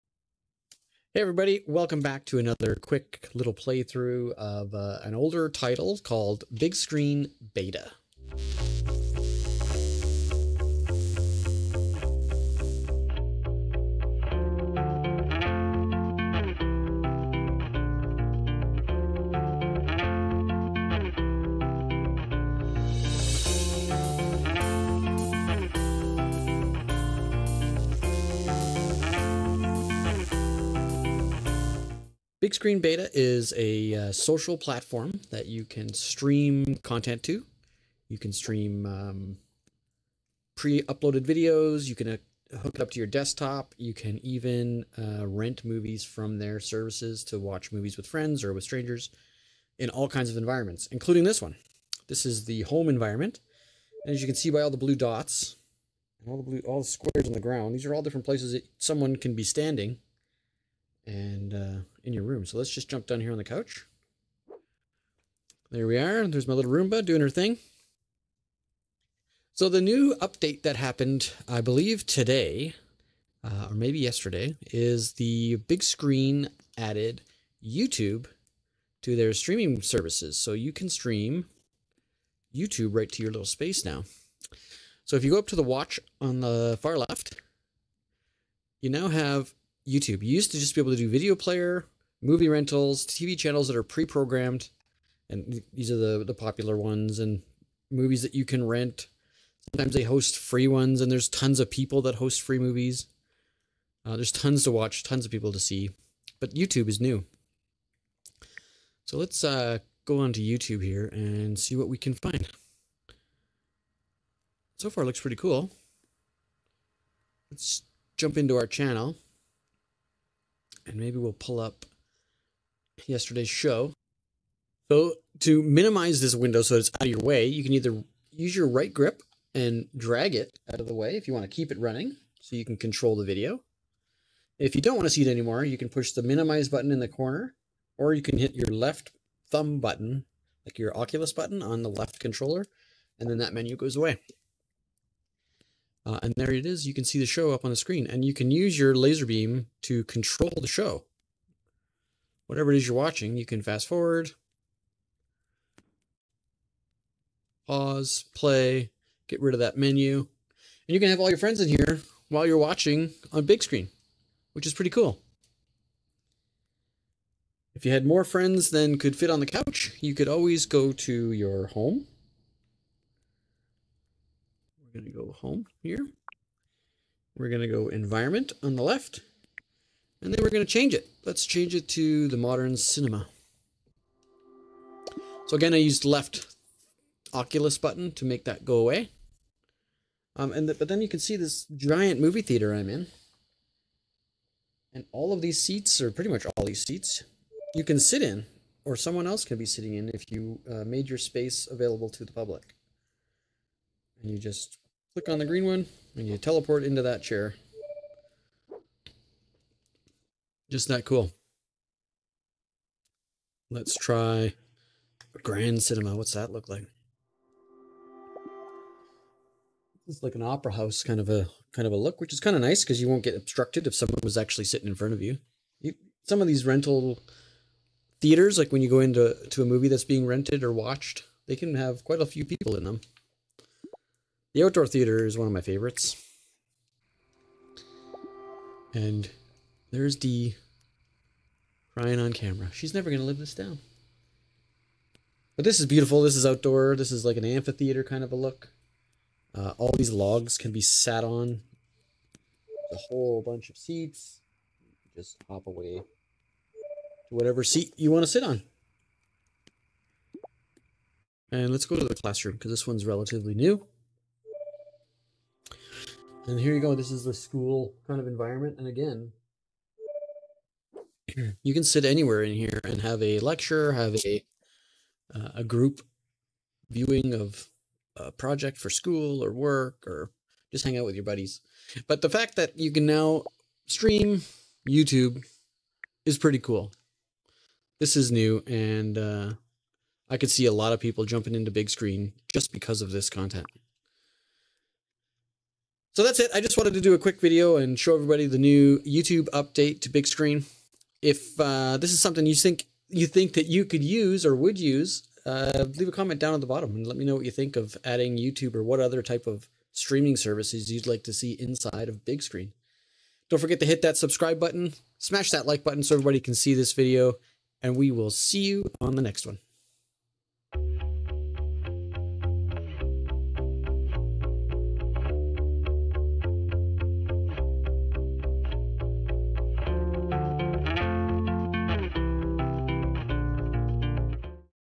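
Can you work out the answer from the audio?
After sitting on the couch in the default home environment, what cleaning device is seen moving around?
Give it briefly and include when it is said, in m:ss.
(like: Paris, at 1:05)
Roomba, at 1:06.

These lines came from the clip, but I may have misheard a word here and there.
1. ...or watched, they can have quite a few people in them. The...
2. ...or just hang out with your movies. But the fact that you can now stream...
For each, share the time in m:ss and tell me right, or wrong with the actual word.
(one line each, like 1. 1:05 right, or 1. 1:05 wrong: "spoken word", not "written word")
1. 3:50 right
2. 4:40 wrong: "buddies", not "movies".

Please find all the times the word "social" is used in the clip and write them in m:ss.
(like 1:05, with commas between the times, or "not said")
0:34.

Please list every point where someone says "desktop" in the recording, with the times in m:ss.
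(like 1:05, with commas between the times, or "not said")
0:43.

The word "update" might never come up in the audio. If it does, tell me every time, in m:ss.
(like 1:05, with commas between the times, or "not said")
1:10, 4:59.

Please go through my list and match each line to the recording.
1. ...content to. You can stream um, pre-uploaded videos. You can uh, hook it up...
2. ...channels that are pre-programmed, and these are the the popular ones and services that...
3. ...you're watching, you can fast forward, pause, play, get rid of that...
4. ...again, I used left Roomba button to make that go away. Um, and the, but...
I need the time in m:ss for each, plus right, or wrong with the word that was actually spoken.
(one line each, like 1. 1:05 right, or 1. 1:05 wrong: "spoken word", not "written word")
1. 0:36 right
2. 1:33 wrong: "movies", not "services"
3. 2:32 right
4. 3:05 wrong: "Oculus", not "Roomba".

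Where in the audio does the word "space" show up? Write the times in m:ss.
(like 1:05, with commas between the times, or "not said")
1:23, 3:21.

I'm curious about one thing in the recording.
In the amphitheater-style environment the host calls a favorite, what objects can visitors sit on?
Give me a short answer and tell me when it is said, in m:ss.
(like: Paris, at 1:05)
Logs, at 4:10.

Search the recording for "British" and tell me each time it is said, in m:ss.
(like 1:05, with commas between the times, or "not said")
not said.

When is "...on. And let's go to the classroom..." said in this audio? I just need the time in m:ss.
4:18.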